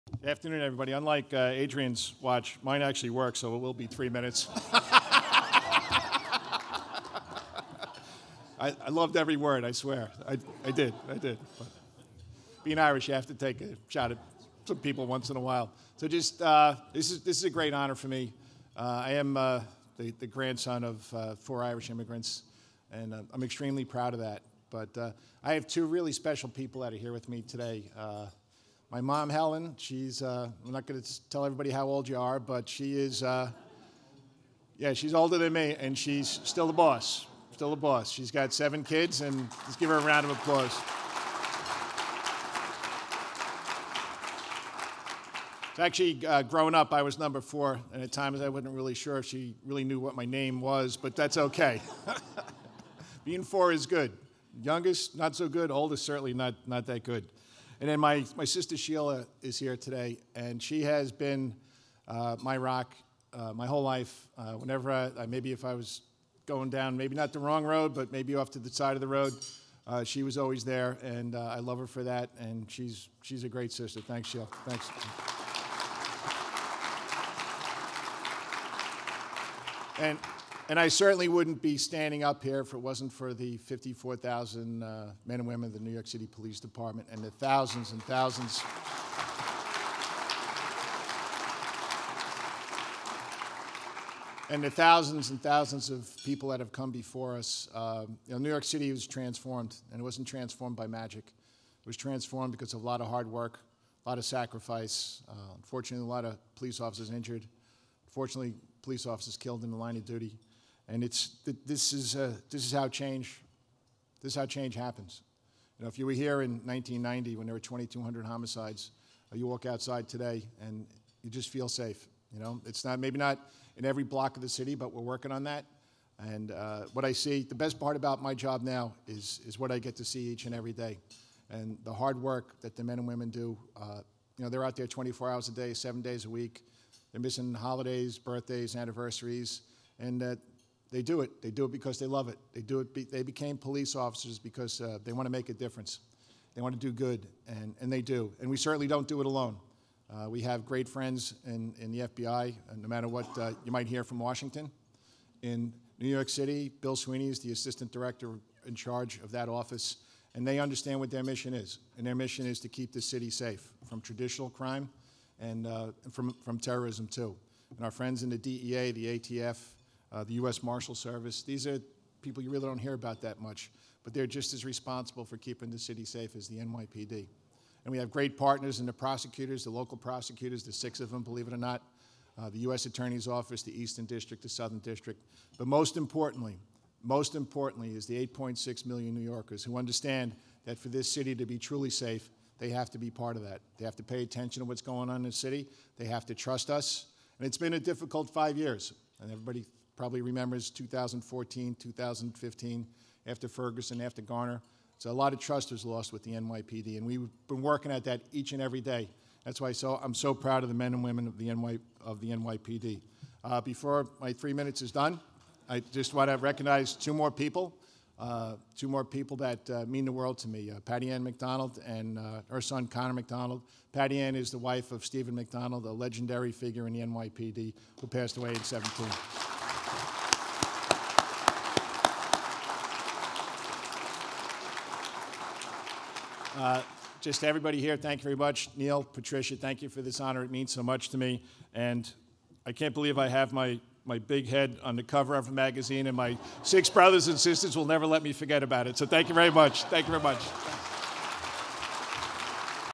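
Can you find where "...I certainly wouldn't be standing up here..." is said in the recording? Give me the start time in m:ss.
1:20.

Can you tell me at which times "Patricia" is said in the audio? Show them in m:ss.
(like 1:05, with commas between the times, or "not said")
3:59.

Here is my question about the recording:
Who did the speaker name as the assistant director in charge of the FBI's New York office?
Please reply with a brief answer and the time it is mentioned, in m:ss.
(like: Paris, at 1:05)
Bill Sweeney, at 2:36.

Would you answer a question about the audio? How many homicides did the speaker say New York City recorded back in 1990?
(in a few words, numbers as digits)
2,200.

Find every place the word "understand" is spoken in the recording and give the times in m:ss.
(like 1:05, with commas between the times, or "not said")
2:40, 3:09.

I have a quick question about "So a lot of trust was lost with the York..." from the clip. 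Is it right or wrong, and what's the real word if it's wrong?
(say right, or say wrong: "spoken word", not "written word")
wrong: "NYPD", not "York".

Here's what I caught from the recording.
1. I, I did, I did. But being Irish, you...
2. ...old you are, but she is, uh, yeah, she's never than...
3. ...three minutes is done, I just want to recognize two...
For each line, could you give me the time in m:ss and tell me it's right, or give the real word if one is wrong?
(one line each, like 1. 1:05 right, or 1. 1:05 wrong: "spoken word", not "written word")
1. 0:10 right
2. 0:31 wrong: "older", not "never"
3. 3:34 right.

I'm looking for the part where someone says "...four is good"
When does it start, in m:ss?
0:53.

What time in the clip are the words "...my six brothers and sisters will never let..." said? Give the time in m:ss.
4:06.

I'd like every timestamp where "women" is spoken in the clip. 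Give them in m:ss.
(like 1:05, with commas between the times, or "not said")
1:25, 2:13, 3:31.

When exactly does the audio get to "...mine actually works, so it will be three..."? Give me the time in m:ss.
0:02.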